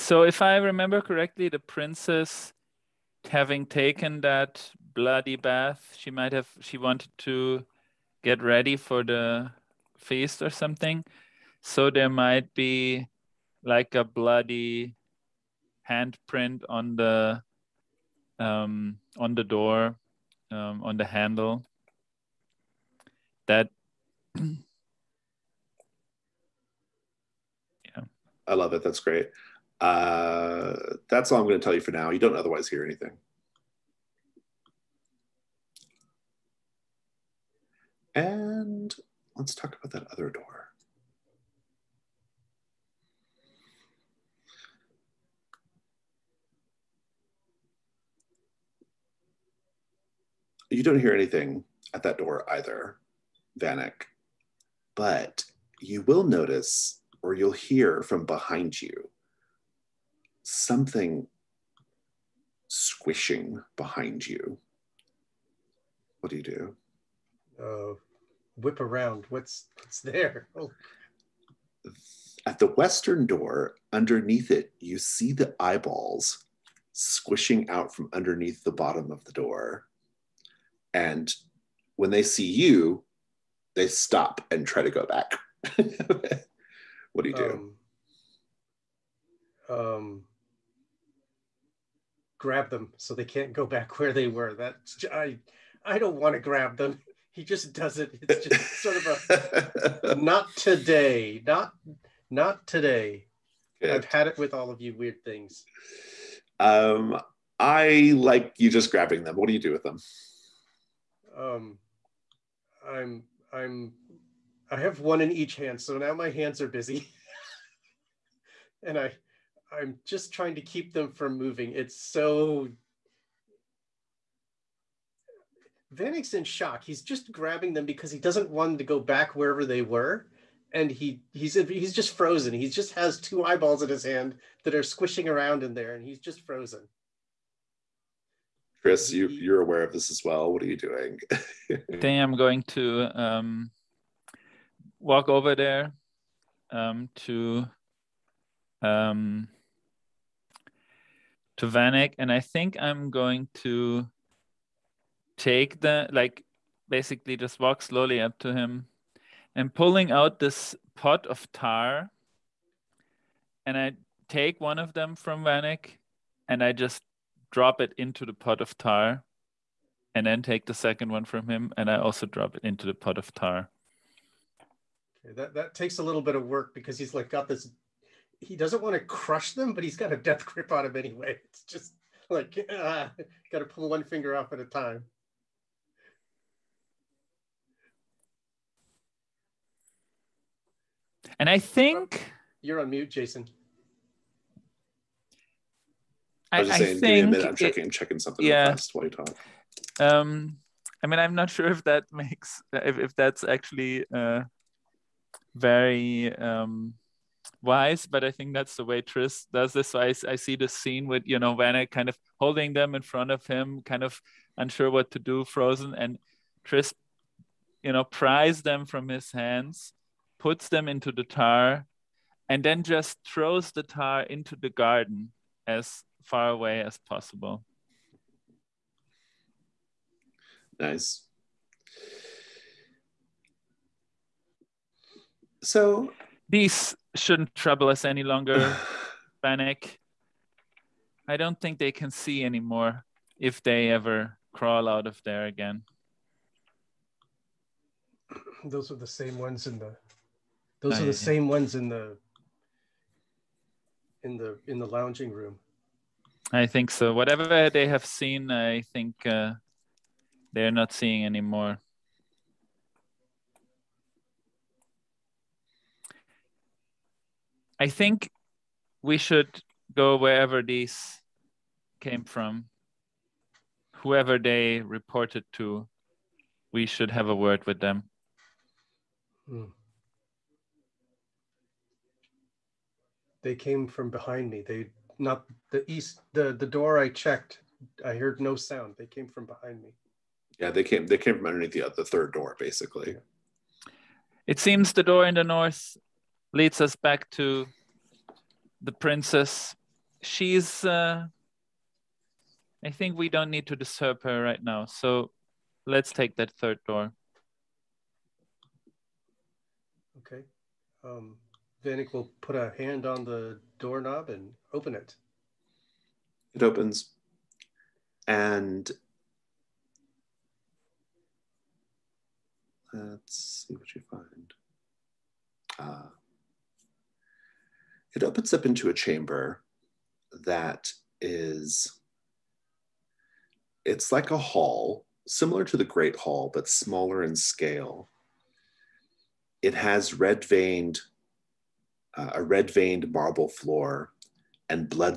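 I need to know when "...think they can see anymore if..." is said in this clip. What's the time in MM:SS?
04:01.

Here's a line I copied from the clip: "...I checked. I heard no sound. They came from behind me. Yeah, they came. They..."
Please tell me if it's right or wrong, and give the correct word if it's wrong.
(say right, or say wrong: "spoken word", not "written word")
right.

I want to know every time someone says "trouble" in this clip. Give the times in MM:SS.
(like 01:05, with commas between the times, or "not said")
03:57.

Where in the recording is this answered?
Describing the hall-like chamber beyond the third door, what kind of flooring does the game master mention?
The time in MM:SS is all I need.
05:42.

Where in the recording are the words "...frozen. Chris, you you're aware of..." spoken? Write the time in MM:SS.
02:16.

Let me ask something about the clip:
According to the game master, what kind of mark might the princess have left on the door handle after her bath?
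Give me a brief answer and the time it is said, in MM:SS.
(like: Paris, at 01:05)
bloody handprint, at 00:14.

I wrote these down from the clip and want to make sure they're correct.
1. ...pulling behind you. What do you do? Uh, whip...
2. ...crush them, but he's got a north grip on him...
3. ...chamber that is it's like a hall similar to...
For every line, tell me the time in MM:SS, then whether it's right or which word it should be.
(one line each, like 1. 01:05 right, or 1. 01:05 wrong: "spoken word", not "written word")
1. 01:02 wrong: "squishing", not "pulling"
2. 02:59 wrong: "death", not "north"
3. 05:28 right.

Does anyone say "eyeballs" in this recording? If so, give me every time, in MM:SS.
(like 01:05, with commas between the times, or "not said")
01:15, 02:13.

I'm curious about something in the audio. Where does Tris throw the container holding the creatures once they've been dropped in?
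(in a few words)
into the garden.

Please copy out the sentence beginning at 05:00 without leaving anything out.
She's, uh, I think we don't need to disturb her right now.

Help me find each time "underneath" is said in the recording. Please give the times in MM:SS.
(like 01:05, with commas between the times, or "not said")
01:13, 01:18, 04:51.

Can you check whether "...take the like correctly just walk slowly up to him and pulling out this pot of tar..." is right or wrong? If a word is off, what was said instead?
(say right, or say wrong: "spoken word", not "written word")
wrong: "basically", not "correctly".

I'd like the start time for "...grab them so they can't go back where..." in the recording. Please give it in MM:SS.
01:32.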